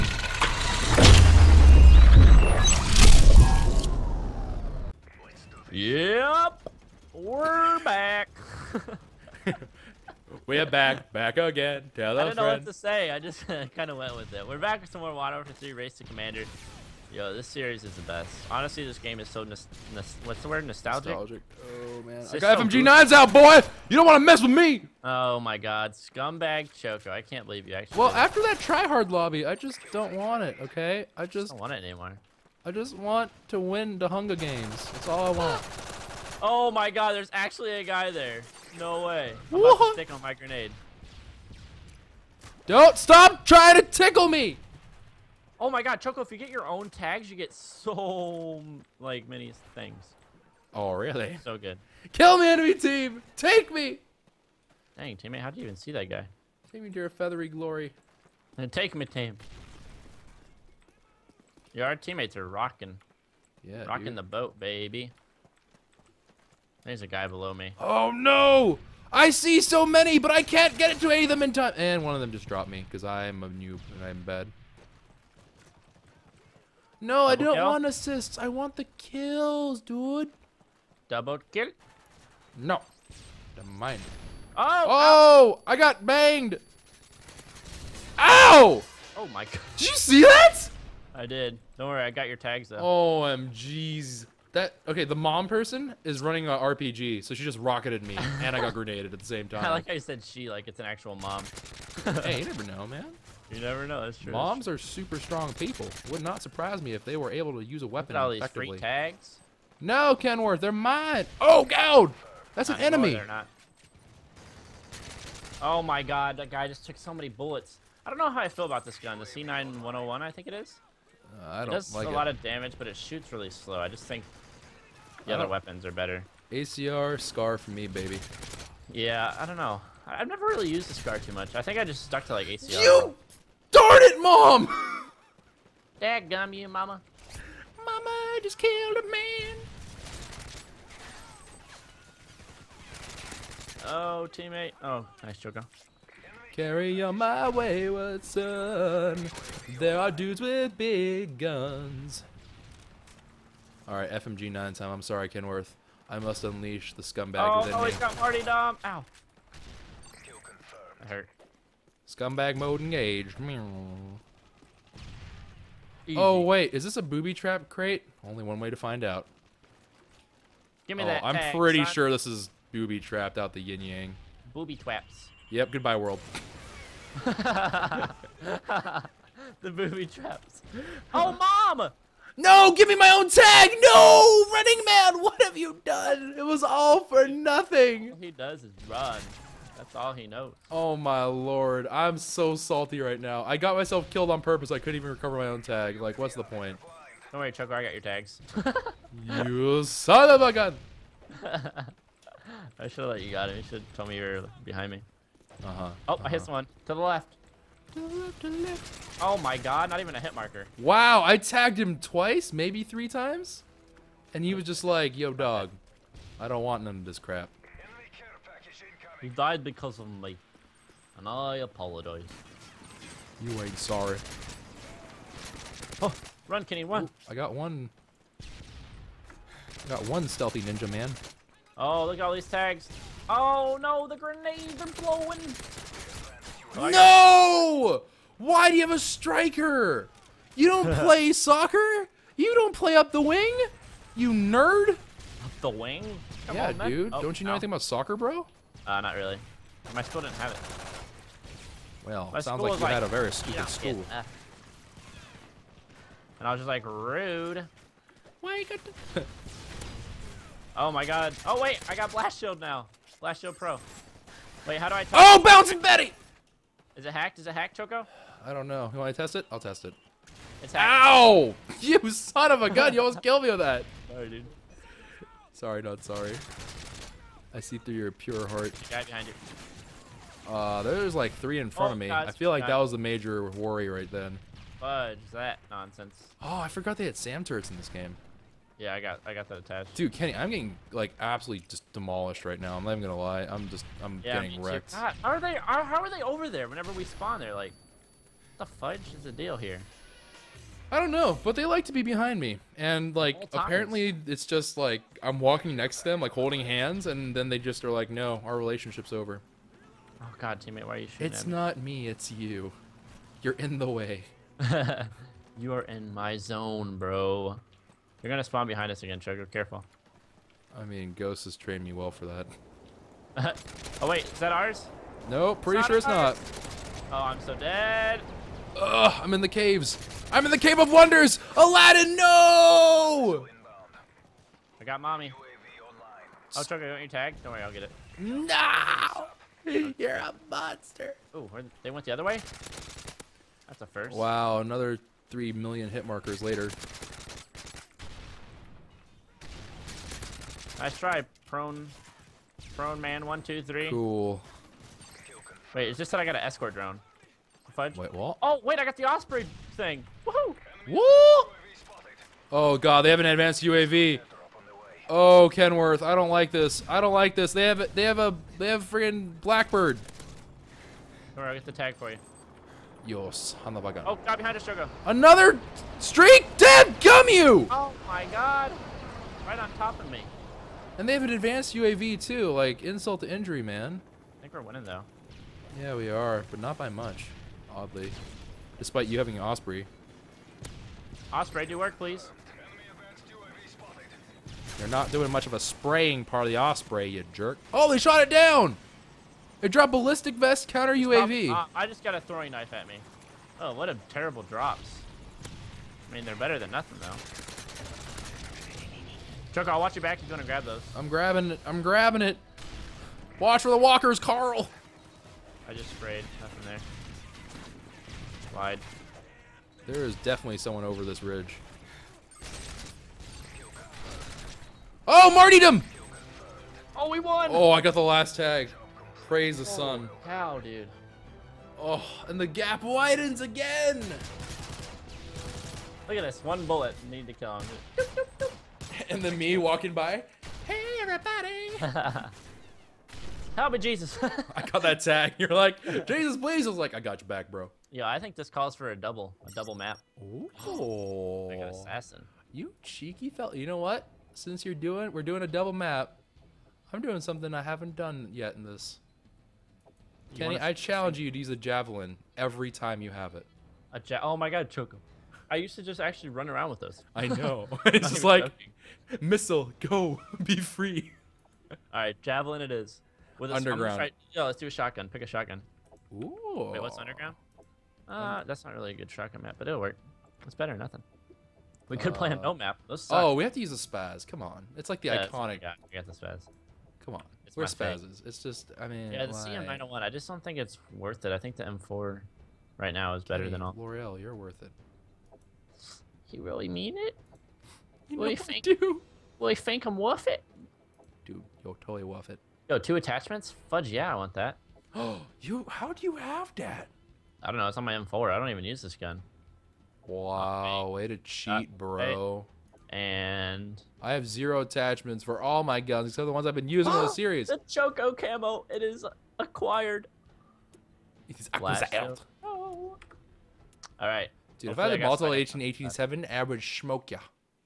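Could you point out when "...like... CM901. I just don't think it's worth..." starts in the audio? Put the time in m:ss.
8:09.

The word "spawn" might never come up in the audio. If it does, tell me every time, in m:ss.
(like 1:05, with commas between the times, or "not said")
4:57, 5:18.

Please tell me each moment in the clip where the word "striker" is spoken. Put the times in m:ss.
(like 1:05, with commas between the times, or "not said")
3:58.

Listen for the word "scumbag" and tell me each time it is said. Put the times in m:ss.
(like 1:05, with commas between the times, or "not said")
0:25, 2:37, 2:42.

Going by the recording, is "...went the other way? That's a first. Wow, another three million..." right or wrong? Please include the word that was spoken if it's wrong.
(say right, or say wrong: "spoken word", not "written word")
right.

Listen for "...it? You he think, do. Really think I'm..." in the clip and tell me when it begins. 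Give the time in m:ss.
8:16.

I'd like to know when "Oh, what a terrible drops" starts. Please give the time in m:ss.
6:43.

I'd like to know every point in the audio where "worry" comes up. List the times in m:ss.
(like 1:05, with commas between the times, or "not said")
1:31, 3:17, 4:43, 5:37.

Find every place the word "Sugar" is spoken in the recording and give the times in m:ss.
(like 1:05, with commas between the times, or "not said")
5:19, 5:36.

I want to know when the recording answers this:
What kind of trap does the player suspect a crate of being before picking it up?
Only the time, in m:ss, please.
2:47.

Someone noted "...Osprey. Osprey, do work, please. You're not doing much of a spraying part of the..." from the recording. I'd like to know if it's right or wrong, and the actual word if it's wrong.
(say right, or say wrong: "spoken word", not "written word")
right.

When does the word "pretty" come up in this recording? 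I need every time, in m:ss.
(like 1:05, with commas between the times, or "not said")
2:51, 5:25.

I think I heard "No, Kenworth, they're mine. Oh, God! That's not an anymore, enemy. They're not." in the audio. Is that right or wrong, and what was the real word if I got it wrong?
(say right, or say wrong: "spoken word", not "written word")
right.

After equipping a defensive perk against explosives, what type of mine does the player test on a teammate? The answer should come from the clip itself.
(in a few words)
Bouncing Betty.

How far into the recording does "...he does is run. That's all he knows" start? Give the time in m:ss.
3:08.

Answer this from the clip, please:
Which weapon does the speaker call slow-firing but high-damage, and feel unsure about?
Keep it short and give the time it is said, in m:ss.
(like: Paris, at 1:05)
CM901, at 1:59.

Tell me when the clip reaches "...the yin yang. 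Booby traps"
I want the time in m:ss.
2:53.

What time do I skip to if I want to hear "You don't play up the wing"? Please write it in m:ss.
4:02.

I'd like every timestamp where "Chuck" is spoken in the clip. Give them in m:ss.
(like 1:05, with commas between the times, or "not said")
3:17, 6:49.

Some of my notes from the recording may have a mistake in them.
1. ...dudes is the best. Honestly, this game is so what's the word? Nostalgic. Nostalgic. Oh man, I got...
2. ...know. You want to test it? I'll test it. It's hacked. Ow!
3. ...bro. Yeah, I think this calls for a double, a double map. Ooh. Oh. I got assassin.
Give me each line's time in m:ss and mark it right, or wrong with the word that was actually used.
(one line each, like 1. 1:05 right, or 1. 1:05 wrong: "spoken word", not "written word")
1. 0:17 wrong: "series", not "dudes"
2. 4:28 right
3. 7:27 right.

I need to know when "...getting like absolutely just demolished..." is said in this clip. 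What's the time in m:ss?
4:50.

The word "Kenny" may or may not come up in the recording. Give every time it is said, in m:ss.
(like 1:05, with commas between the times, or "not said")
3:46, 4:50, 7:40.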